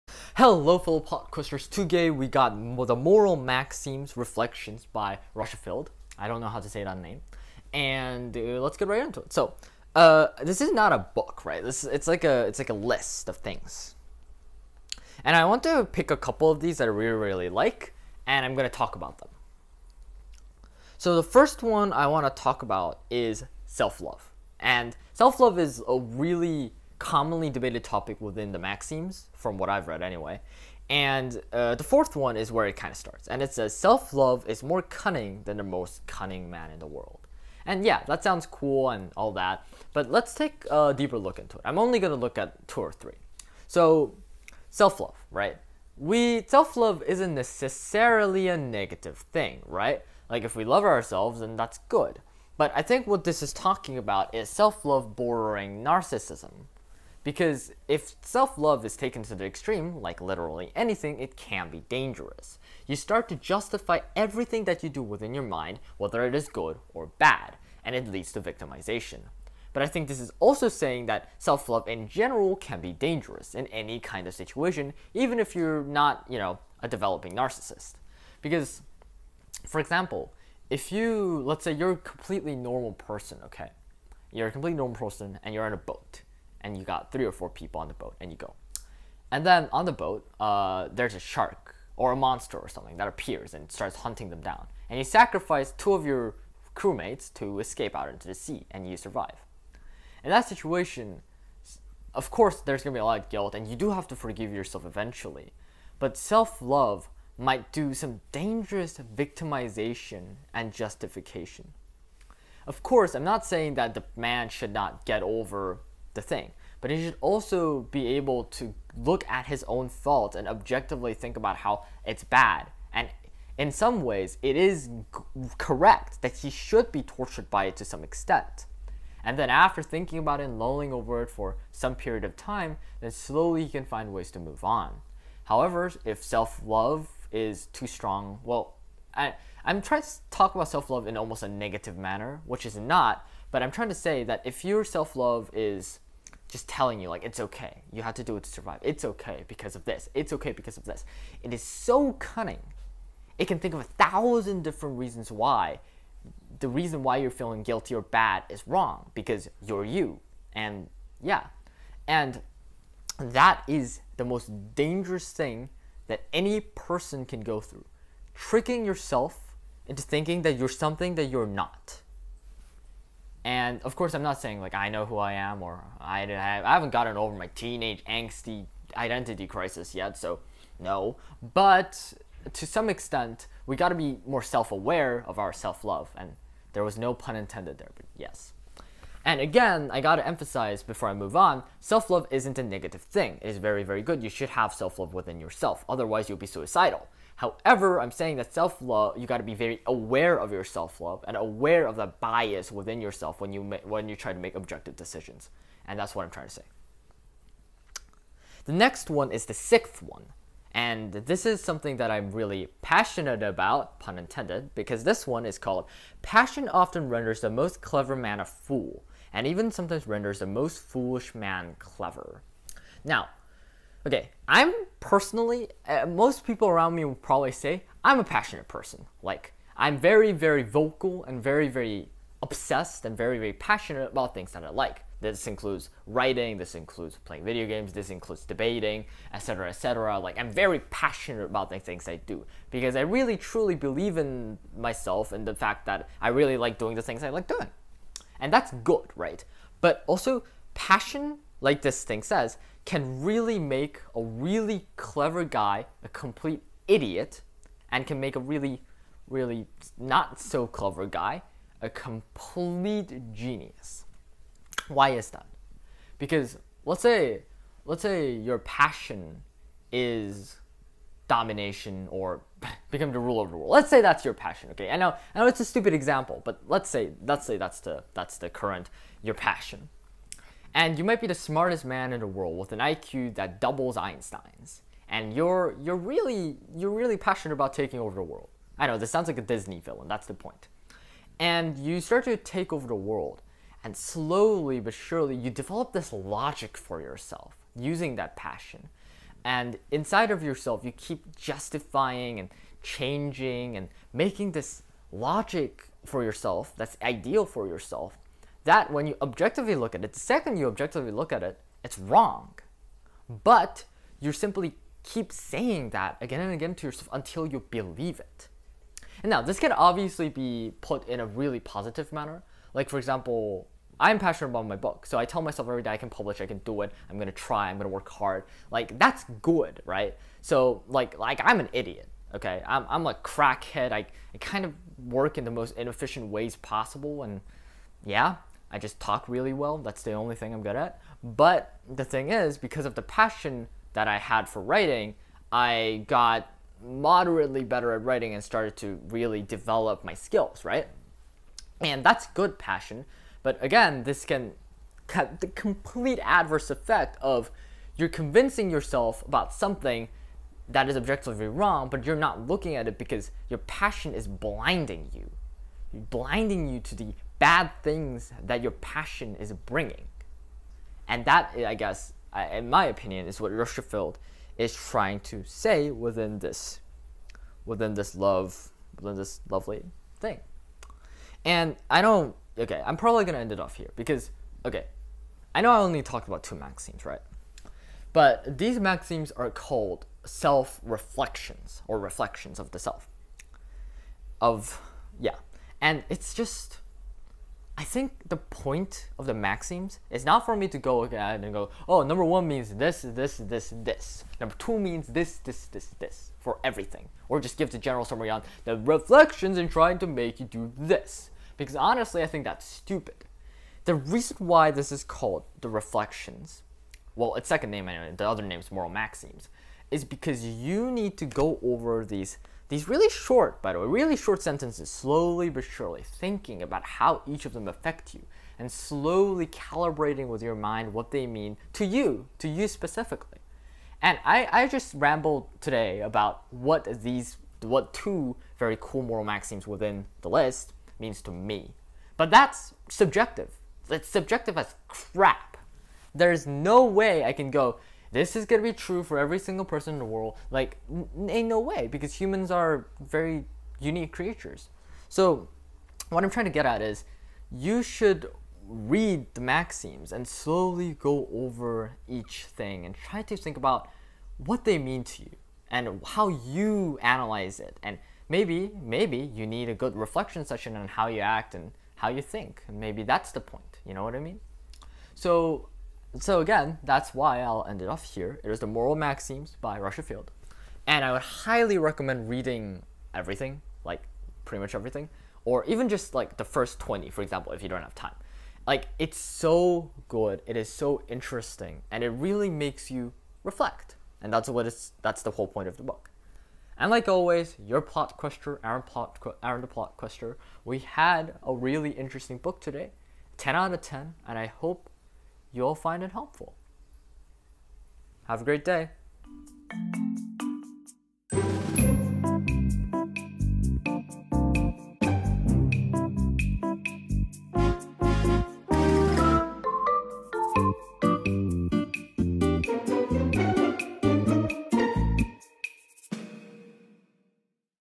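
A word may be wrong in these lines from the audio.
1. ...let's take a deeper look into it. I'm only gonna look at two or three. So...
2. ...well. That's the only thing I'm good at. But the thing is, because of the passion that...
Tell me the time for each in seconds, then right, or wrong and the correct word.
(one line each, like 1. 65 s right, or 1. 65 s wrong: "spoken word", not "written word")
1. 40 s right
2. 339 s right.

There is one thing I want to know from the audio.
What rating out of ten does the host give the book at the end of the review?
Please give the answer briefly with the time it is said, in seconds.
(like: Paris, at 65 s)
10, at 503 s.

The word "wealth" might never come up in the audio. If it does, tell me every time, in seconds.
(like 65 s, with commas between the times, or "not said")
not said.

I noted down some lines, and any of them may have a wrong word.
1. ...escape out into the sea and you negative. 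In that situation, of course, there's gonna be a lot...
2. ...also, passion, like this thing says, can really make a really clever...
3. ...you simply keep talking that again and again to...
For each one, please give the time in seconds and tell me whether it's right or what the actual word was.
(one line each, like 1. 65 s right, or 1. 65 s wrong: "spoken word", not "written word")
1. 97 s wrong: "survive", not "negative"
2. 250 s right
3. 314 s wrong: "saying", not "talking".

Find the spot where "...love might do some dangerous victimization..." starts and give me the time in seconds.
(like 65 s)
106 s.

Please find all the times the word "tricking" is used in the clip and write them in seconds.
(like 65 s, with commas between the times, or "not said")
168 s.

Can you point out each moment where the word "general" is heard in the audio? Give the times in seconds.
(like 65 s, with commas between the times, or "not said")
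72 s, 407 s.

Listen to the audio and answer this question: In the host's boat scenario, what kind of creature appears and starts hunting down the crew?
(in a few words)
A shark.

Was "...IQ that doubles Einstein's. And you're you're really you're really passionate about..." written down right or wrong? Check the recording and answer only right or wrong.
right.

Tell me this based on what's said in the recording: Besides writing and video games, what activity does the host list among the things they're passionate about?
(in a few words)
Debating.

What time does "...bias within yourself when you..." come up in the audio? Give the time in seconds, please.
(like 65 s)
202 s.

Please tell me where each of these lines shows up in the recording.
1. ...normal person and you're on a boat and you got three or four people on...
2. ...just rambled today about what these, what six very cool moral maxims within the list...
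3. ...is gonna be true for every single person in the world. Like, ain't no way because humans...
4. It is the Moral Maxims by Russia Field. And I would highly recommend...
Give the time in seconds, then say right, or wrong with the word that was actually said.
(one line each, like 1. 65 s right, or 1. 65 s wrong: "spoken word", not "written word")
1. 84 s right
2. 434 s wrong: "two", not "six"
3. 448 s right
4. 478 s right.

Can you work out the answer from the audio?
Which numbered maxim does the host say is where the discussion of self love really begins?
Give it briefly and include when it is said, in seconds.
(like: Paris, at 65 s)
4, at 31 s.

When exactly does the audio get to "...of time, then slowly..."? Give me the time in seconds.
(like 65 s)
132 s.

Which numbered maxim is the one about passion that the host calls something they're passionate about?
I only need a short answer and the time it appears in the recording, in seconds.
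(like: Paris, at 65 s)
6, at 209 s.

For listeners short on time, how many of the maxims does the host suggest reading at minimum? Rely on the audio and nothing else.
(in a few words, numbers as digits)
The first 20.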